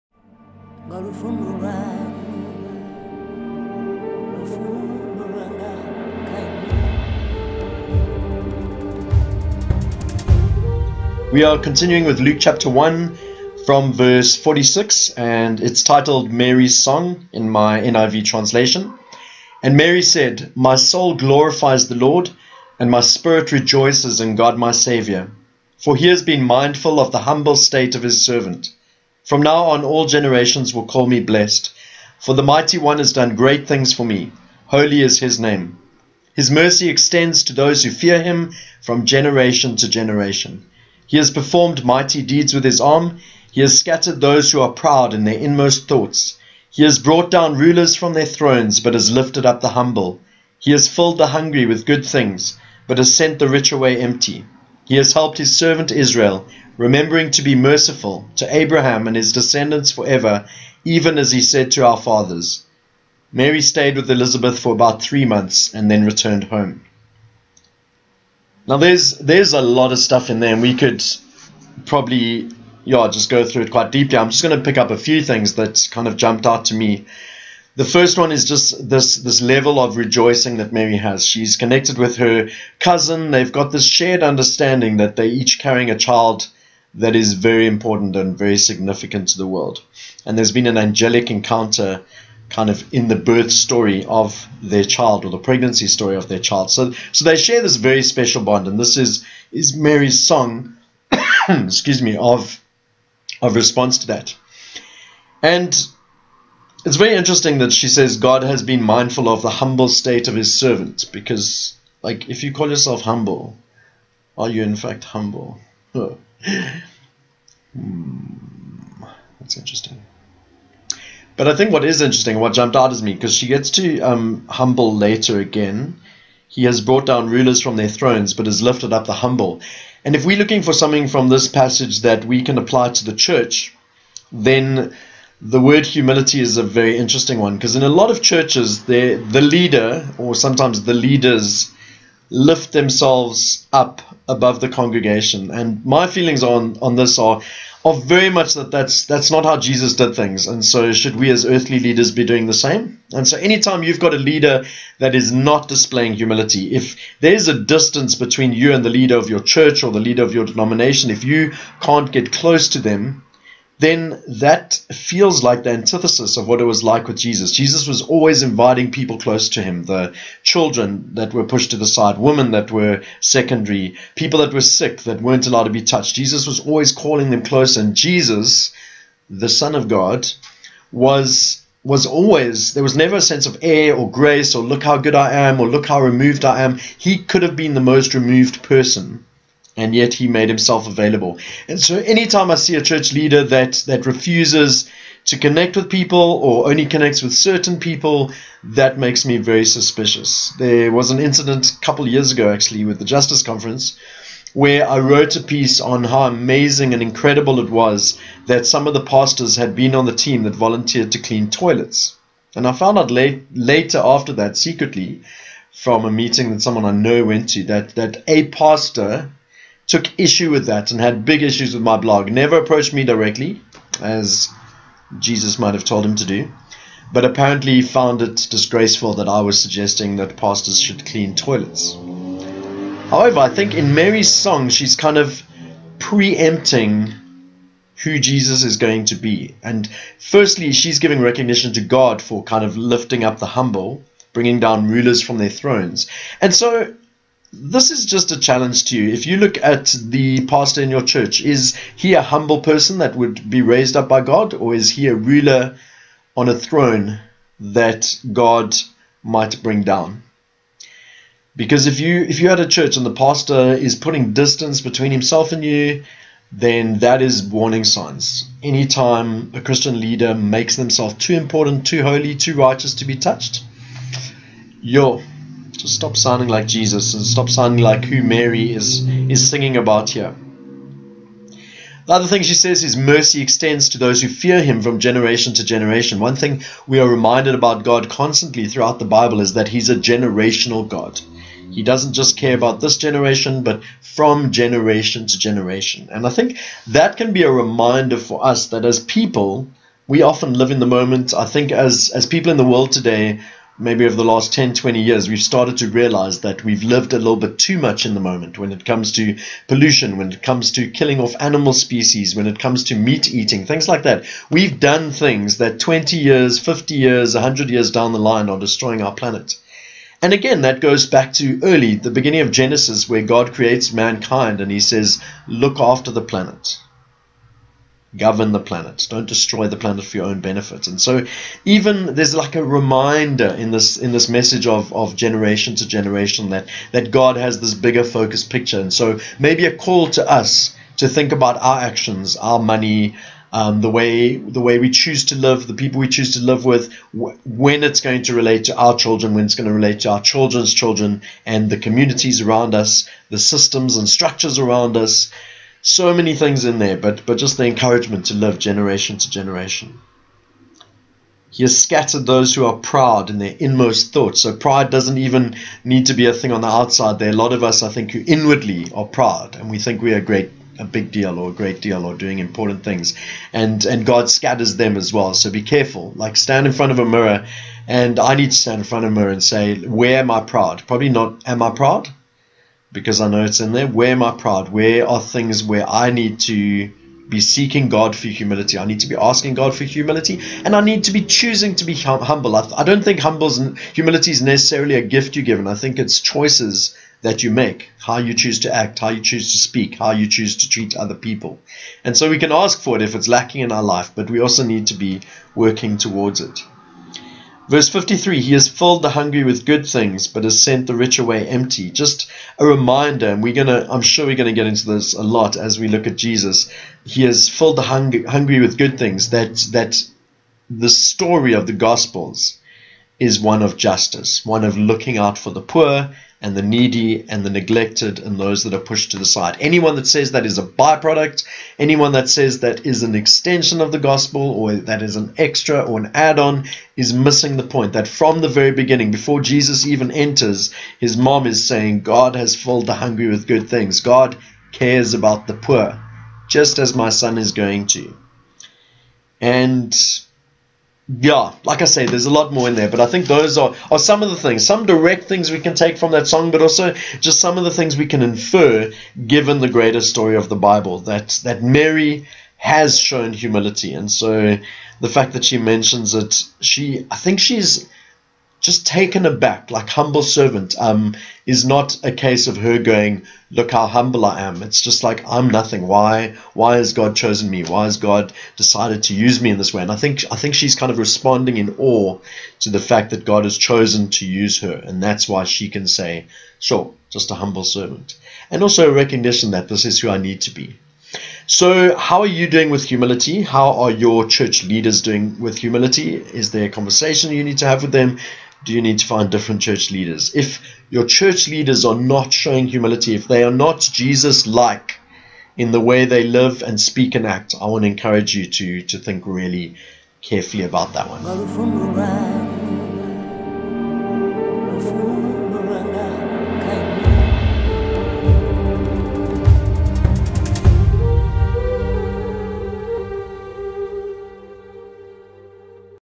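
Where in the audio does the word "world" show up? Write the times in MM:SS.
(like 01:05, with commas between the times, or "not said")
01:29, 05:02.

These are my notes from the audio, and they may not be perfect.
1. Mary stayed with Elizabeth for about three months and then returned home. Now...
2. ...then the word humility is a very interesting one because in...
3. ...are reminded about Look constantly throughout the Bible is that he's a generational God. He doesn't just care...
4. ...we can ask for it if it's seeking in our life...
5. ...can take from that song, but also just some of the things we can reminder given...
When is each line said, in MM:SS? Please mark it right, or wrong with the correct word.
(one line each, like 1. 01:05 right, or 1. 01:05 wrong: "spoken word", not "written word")
1. 01:03 right
2. 02:14 right
3. 04:46 wrong: "God", not "Look"
4. 06:42 wrong: "lacking", not "seeking"
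5. 07:35 wrong: "infer", not "reminder".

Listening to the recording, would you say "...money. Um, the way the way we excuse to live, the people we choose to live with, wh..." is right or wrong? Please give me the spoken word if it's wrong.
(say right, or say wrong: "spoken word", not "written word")
wrong: "choose", not "excuse".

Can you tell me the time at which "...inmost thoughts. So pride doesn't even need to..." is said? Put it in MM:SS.
06:03.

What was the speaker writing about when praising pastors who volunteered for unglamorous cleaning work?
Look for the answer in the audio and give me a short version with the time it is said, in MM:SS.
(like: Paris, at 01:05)
The Justice Conference, at 03:23.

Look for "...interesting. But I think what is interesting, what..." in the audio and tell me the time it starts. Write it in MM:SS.
01:59.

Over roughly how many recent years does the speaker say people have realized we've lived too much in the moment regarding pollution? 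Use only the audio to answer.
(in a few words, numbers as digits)
10, 20 years.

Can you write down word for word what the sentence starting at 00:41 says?
He has performed mighty deeds with his arm.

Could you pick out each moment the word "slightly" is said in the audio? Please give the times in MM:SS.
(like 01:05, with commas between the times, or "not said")
not said.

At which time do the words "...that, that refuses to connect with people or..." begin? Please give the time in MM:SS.
03:13.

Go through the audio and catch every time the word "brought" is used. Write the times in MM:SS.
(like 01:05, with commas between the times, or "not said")
00:46, 02:06.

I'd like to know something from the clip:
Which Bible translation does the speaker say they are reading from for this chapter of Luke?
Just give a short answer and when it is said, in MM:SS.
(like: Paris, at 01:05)
NIV, at 00:17.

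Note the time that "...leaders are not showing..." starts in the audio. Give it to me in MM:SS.
08:21.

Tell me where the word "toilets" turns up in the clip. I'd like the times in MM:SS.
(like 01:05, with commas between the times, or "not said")
03:31, 03:51.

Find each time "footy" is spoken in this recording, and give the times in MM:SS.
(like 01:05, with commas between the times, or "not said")
not said.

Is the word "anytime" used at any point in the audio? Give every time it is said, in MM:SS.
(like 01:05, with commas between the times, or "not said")
02:33, 03:11, 04:28.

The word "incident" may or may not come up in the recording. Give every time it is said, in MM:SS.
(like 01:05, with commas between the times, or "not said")
03:21.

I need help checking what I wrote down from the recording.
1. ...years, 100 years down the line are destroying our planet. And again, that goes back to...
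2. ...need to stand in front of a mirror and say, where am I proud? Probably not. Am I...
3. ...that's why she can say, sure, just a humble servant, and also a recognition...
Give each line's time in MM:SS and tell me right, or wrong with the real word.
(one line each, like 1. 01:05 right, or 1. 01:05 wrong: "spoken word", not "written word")
1. 05:16 right
2. 06:18 right
3. 08:05 right.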